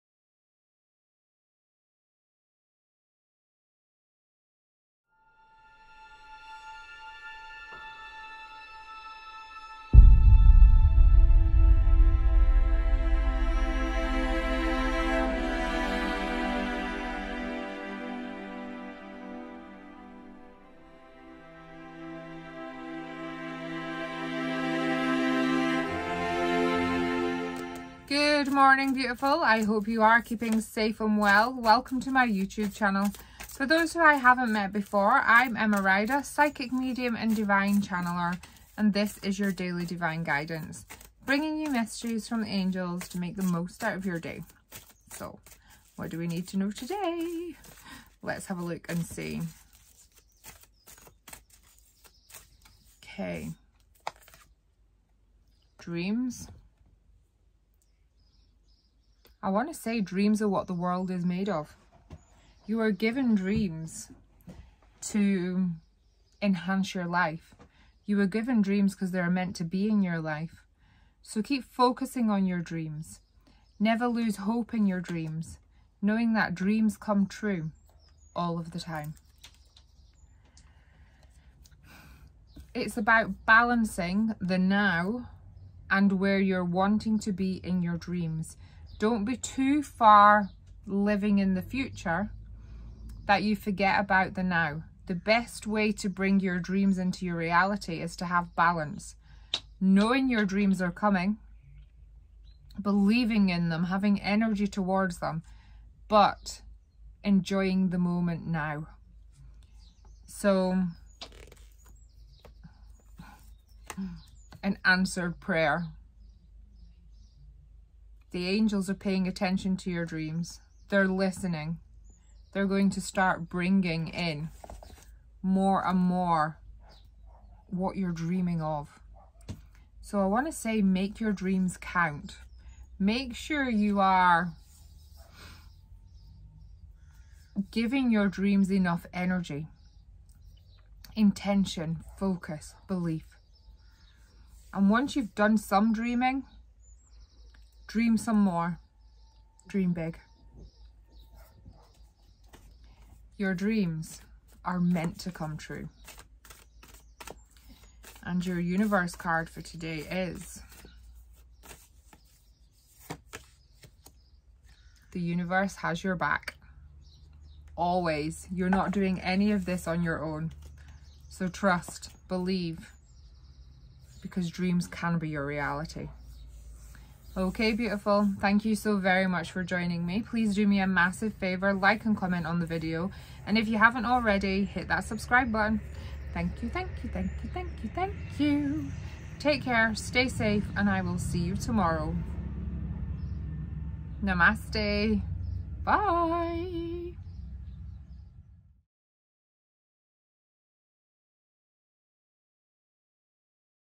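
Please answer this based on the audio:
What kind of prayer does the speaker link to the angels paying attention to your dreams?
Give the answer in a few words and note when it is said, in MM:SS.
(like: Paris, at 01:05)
An answered prayer, at 01:54.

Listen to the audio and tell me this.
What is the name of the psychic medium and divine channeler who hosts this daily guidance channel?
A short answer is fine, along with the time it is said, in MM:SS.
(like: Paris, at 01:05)
Emma Ryder, at 00:35.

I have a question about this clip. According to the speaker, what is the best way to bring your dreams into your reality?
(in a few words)
Balance.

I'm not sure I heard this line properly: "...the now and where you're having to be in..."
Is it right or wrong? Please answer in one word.
wrong.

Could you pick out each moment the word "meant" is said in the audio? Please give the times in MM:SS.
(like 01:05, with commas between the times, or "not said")
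01:09, 02:34.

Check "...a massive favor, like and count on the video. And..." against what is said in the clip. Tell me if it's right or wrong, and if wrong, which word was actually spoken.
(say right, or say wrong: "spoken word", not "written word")
wrong: "comment", not "count".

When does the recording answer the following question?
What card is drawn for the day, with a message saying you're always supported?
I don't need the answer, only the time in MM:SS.
02:38.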